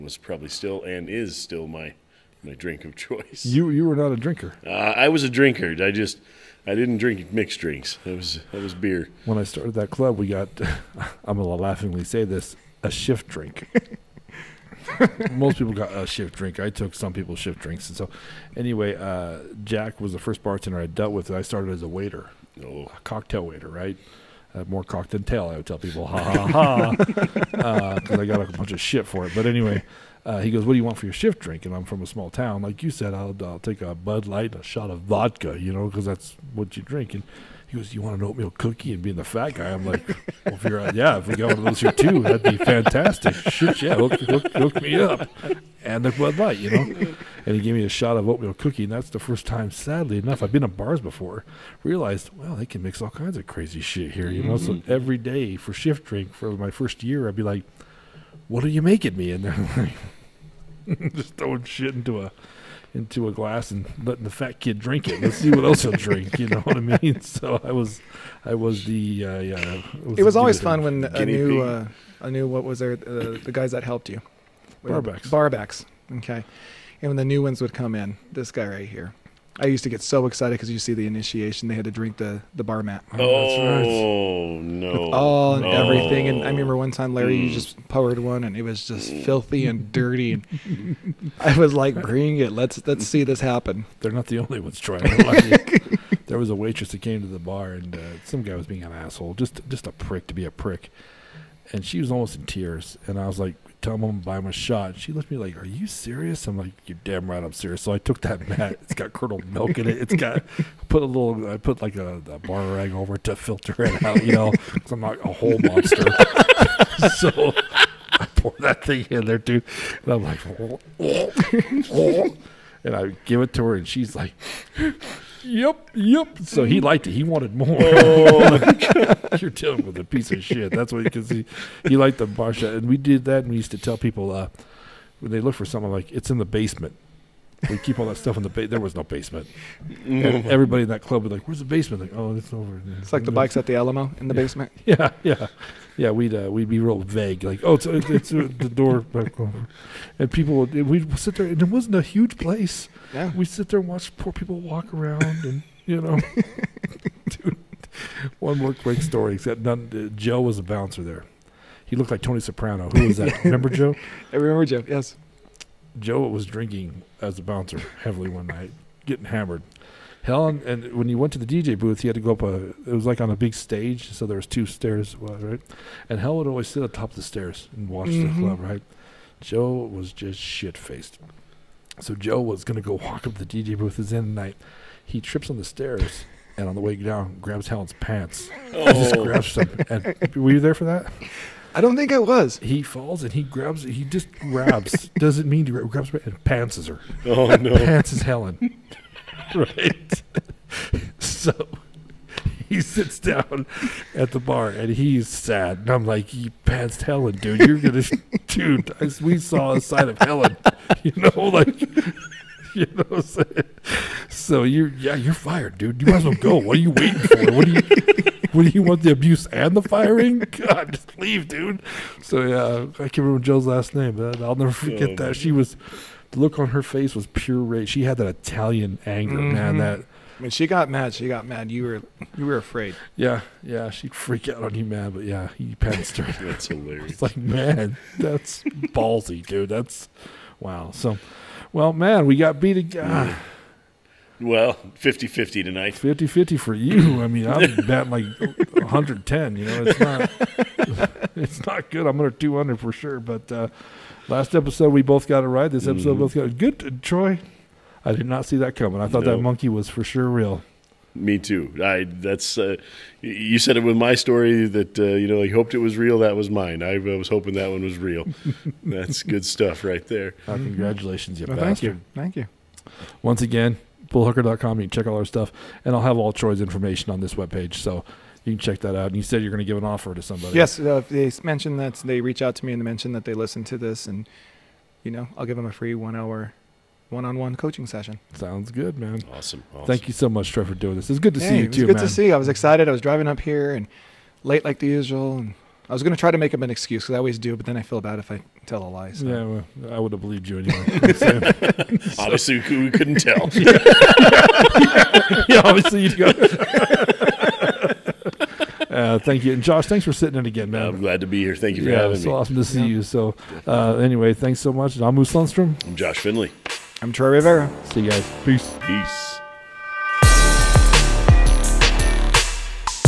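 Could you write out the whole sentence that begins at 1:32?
Let's let's see this happen." They're not the only ones trying.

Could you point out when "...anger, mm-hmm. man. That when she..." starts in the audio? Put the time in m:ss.
3:49.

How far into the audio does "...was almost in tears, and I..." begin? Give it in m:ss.
1:41.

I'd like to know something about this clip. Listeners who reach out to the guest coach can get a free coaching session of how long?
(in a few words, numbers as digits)
1 hour.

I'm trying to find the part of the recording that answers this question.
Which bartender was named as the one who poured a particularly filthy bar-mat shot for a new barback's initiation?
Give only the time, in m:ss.
1:27.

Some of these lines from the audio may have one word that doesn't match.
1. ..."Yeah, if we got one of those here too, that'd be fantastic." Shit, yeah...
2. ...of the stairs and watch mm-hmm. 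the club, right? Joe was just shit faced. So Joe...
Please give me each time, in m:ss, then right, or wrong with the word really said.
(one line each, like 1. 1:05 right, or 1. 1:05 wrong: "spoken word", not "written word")
1. 0:40 right
2. 2:57 right.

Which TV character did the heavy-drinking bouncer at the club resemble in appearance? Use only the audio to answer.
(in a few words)
Tony Soprano.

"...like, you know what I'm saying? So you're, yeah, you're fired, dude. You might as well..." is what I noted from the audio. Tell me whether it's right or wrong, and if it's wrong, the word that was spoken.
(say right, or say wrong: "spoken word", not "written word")
right.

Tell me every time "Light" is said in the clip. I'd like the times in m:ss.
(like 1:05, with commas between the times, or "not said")
0:34, 0:46.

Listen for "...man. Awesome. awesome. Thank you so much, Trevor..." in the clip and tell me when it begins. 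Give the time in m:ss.
4:48.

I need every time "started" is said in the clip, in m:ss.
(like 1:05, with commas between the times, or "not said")
0:09, 0:21.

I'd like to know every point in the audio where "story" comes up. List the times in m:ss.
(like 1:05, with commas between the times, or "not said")
2:39, 4:24.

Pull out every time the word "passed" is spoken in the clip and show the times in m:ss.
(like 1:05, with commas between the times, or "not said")
3:26.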